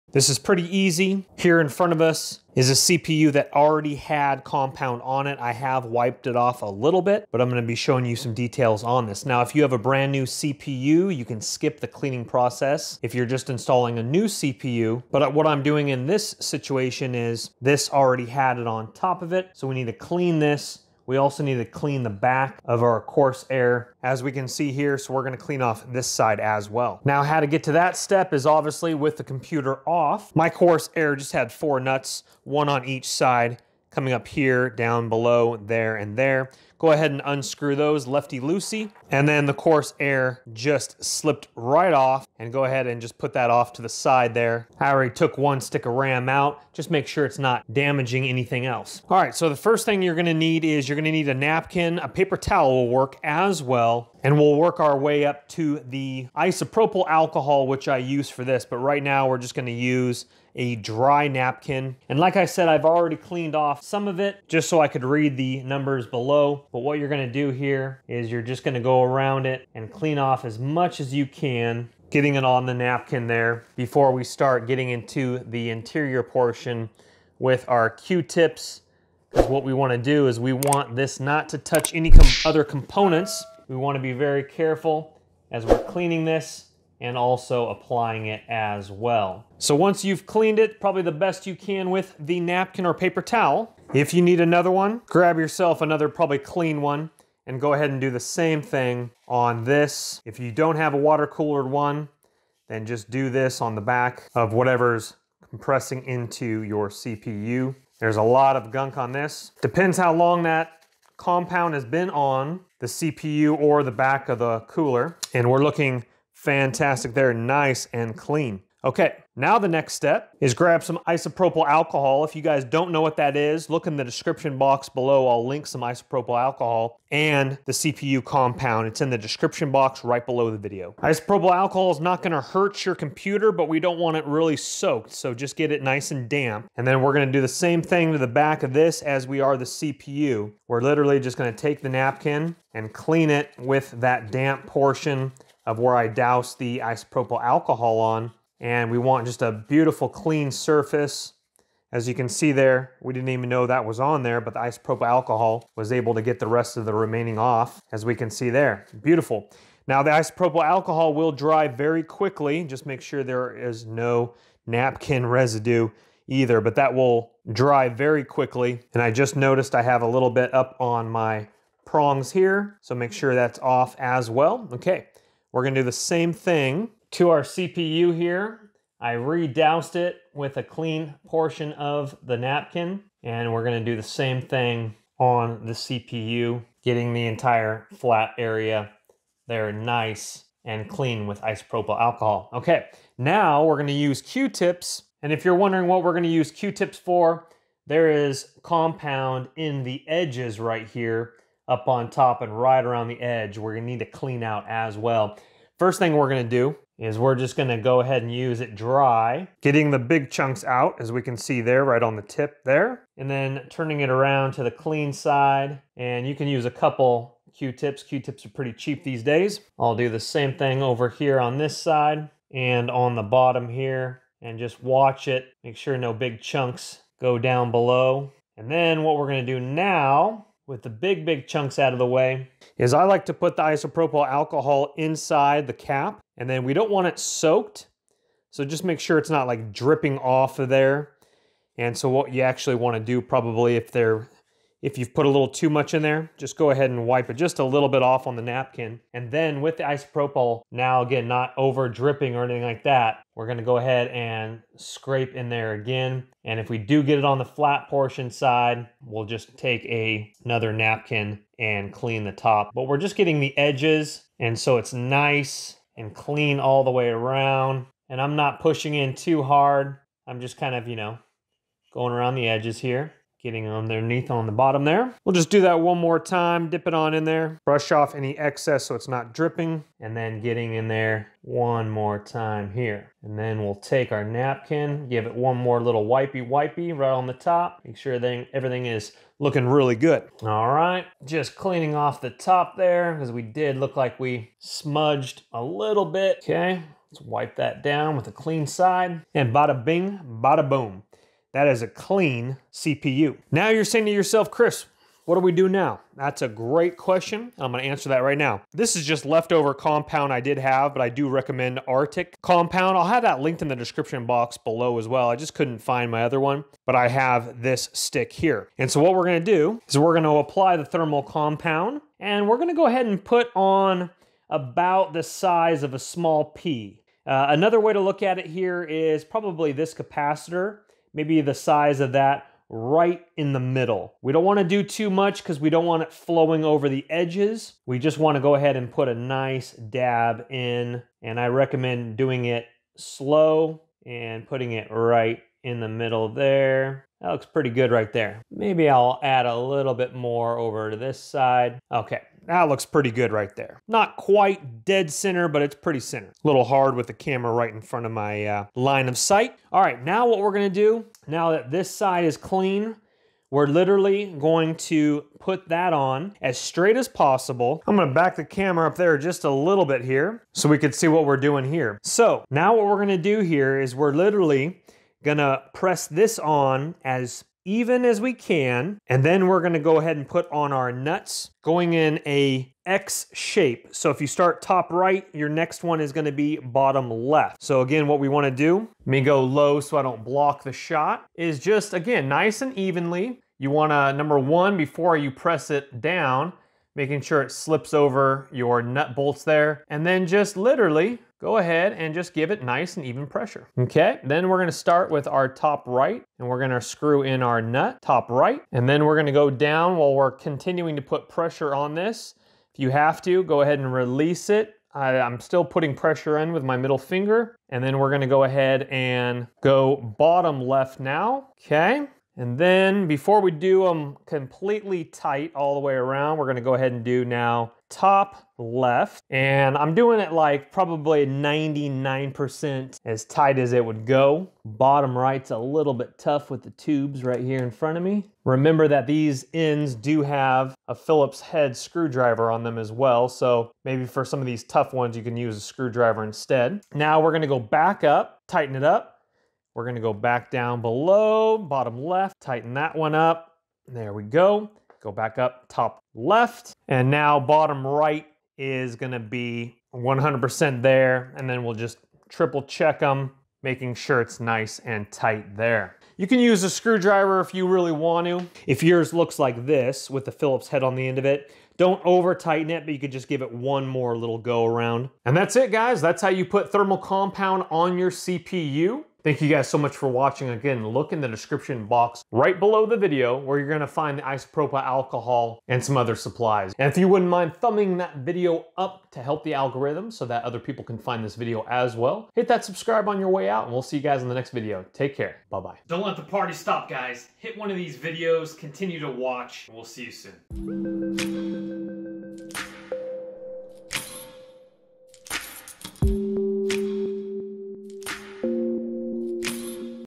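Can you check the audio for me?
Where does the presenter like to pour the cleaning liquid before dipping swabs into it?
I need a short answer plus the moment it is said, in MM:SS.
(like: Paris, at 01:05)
Inside the cap, at 03:54.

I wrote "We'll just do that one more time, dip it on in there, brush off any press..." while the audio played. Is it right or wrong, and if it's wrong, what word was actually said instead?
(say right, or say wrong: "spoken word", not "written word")
wrong: "excess", not "press".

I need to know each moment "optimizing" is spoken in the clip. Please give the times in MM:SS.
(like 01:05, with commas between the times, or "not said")
not said.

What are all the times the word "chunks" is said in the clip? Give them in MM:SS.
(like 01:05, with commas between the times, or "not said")
03:30, 03:46, 03:51.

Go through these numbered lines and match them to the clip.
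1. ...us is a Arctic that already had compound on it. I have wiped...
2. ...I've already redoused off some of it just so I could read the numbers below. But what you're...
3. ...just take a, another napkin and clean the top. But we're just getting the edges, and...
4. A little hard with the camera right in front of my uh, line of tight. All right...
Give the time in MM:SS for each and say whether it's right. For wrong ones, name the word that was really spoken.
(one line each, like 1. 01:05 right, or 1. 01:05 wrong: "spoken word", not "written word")
1. 00:02 wrong: "CPU", not "Arctic"
2. 01:02 wrong: "cleaned", not "redoused"
3. 04:19 right
4. 05:56 wrong: "sight", not "tight".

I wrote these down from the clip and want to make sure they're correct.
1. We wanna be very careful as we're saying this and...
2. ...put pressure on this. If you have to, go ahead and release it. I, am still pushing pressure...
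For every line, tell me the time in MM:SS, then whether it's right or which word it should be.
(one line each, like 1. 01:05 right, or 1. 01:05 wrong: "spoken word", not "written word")
1. 01:23 wrong: "cleaning", not "saying"
2. 06:51 wrong: "putting", not "pushing".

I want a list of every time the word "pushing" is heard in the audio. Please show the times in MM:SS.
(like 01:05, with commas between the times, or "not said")
04:28.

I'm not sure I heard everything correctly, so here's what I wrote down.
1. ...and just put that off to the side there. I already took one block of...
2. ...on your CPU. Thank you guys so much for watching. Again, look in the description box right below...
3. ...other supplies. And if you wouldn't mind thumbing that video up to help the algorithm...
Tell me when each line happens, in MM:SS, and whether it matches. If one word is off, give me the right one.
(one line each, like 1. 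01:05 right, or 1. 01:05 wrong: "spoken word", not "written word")
1. 00:42 wrong: "stick", not "block"
2. 07:57 right
3. 08:05 right.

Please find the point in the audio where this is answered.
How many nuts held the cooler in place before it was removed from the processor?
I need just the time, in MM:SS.
00:31.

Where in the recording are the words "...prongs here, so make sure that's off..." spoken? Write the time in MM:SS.
02:51.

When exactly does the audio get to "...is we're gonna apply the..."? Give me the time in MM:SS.
05:19.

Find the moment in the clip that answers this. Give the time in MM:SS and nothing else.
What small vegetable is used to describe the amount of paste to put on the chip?
05:25.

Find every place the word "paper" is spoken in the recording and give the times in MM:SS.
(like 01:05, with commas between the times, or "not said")
00:52, 01:32.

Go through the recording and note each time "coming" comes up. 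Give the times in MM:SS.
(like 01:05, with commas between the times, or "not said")
00:33.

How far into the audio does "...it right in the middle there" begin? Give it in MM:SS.
05:44.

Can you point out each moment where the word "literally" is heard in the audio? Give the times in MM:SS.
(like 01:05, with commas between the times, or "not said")
02:20, 06:03, 06:14, 06:40.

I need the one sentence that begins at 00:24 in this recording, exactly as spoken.
So we're gonna clean off this side as well.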